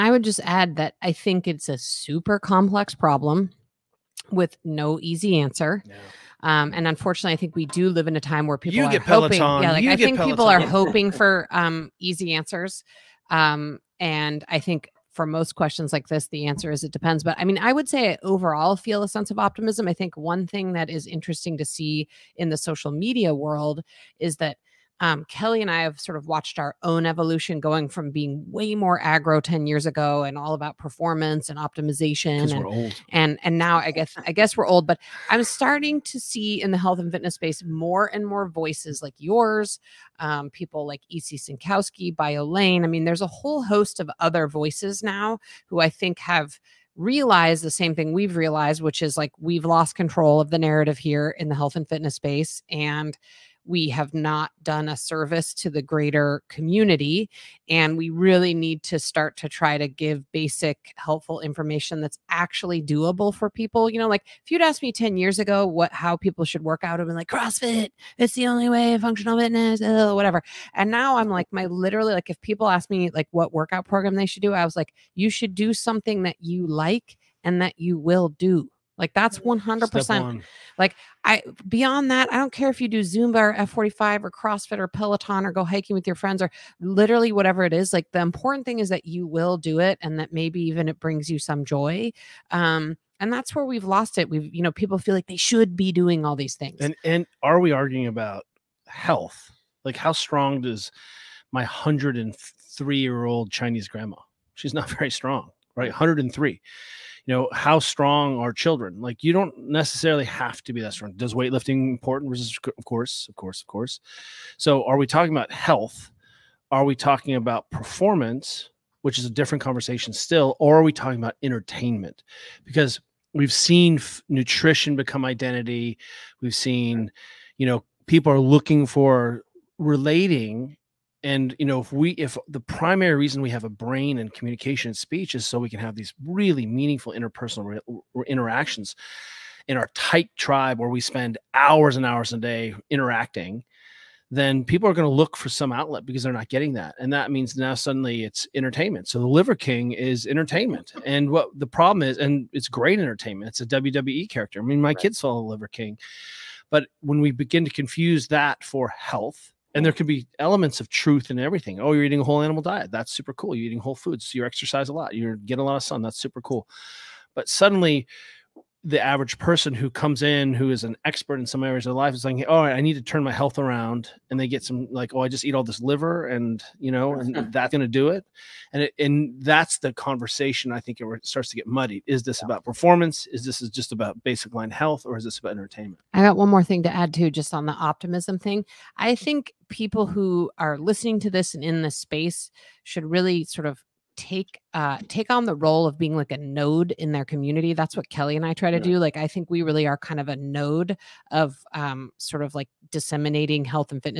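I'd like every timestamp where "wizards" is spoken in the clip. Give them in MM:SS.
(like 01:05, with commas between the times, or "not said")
not said.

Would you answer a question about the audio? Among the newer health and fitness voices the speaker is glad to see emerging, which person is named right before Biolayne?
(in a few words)
EC Synkowski.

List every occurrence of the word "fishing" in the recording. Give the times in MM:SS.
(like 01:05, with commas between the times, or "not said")
not said.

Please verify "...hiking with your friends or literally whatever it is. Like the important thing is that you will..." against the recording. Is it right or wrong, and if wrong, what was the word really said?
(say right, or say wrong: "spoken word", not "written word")
right.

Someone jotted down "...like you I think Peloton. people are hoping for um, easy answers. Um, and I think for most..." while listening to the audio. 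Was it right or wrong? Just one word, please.
right.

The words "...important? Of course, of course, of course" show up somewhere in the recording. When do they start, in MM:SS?
01:51.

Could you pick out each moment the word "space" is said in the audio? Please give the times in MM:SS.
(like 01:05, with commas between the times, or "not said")
00:37, 00:52, 03:11.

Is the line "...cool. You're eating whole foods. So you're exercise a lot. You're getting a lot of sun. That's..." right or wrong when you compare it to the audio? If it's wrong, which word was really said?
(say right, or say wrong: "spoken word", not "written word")
right.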